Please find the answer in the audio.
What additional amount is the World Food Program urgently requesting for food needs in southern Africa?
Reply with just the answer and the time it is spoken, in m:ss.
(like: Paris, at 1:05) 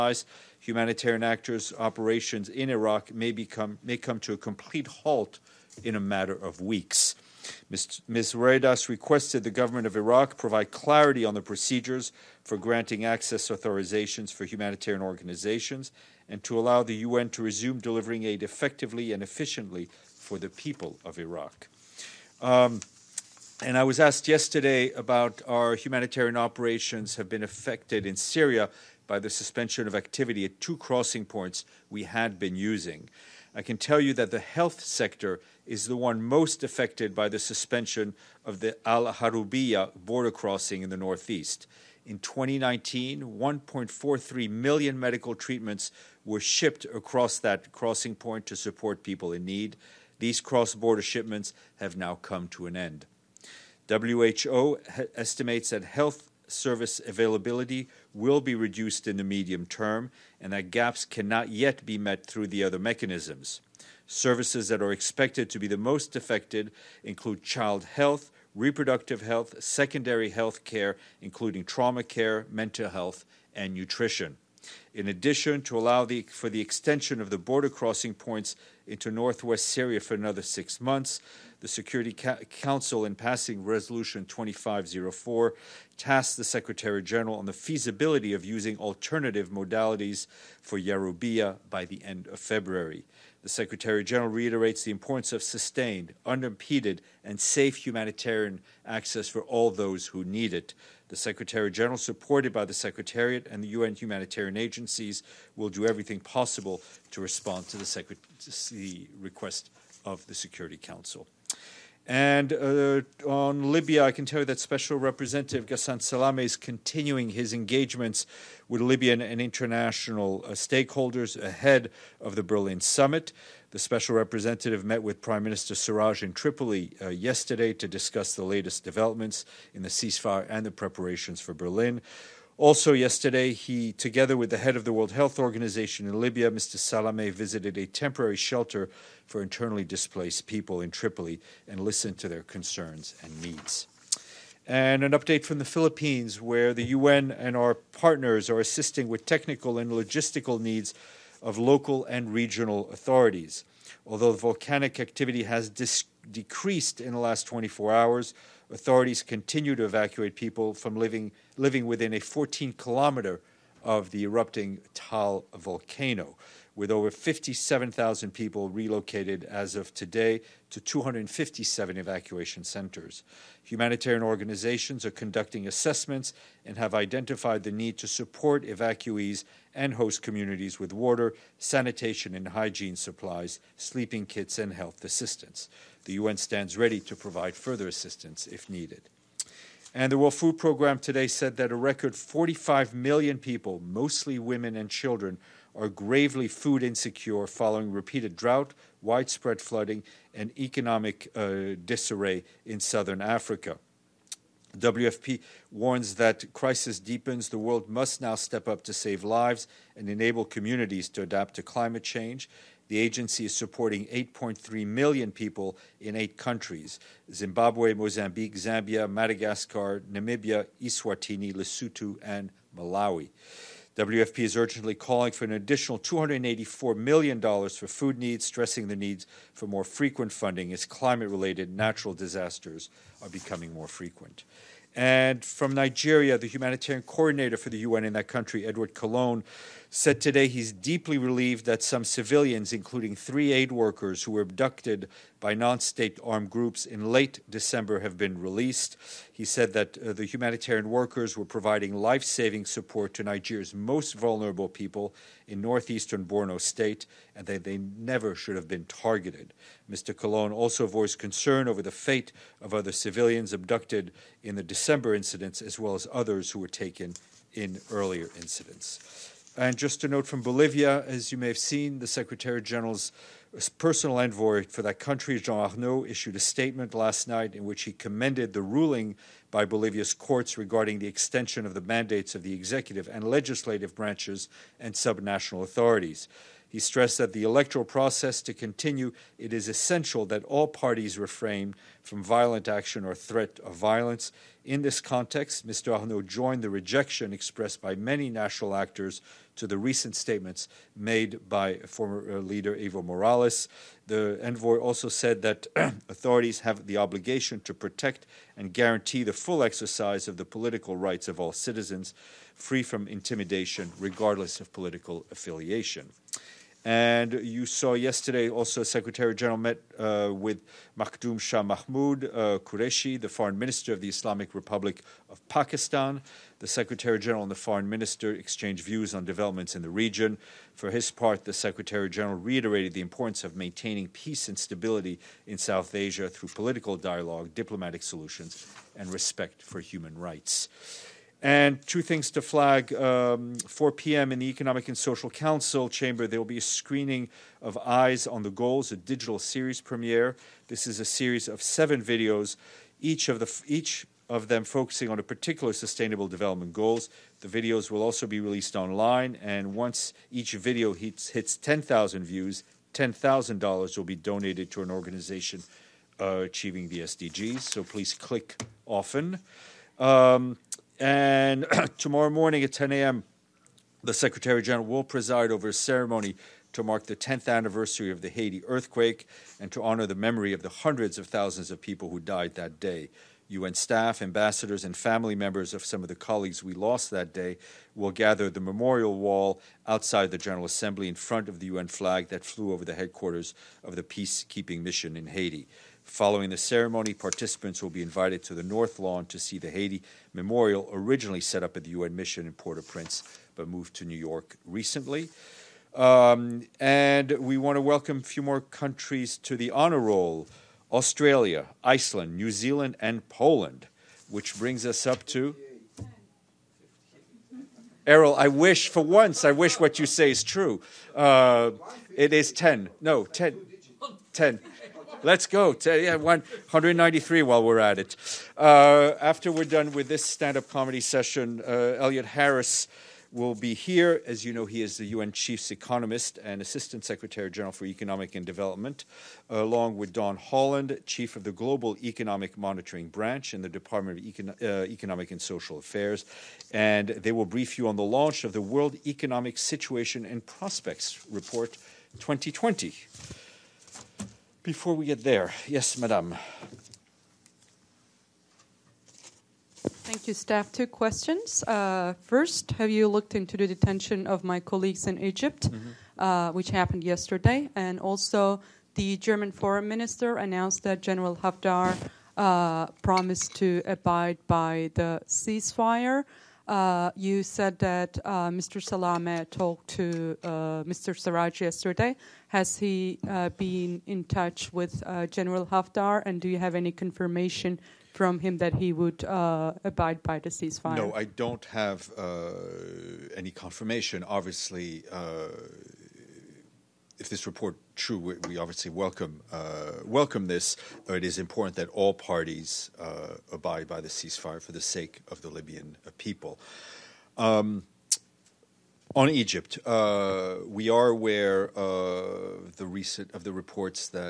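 $284 million, at 3:45.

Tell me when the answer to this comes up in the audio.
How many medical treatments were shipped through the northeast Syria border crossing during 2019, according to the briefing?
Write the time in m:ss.
0:43.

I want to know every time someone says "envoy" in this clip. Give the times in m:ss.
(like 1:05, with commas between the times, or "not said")
4:34, 5:04.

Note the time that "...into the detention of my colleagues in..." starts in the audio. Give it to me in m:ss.
7:43.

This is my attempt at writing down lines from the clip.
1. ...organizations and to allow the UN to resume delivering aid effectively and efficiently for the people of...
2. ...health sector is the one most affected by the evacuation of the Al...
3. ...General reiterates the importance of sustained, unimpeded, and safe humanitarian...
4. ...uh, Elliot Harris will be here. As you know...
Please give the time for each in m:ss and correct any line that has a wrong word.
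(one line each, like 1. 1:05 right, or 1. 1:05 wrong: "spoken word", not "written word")
1. 0:15 right
2. 0:34 wrong: "suspension", not "evacuation"
3. 1:34 right
4. 7:11 right.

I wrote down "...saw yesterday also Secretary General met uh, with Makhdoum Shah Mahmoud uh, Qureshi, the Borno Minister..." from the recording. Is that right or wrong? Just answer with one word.
wrong.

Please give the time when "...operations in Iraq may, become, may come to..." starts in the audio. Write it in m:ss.
0:01.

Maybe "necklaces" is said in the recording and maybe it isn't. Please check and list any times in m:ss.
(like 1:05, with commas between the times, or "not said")
not said.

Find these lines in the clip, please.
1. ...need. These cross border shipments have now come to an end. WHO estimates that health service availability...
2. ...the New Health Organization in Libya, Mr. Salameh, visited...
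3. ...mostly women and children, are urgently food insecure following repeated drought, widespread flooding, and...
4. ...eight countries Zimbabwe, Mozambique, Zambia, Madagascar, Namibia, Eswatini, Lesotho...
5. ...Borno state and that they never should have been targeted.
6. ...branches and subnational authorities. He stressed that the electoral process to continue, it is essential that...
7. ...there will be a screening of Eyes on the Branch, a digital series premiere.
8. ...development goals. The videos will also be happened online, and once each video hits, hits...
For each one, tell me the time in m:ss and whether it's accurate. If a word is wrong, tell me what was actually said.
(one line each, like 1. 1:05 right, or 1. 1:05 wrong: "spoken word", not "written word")
1. 0:49 right
2. 2:14 wrong: "World", not "New"
3. 3:13 wrong: "gravely", not "urgently"
4. 3:36 right
5. 4:16 right
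6. 4:43 right
7. 5:46 wrong: "Goals", not "Branch"
8. 5:56 wrong: "released", not "happened".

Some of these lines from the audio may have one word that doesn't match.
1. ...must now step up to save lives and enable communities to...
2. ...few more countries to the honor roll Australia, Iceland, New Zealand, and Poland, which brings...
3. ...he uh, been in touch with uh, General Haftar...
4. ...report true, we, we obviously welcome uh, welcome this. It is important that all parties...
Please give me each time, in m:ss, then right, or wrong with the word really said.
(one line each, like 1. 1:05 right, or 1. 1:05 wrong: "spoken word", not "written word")
1. 3:27 right
2. 6:48 right
3. 8:02 right
4. 8:17 right.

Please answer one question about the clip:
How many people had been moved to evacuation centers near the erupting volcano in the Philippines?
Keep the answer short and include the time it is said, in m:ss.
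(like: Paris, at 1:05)
57,000, at 2:47.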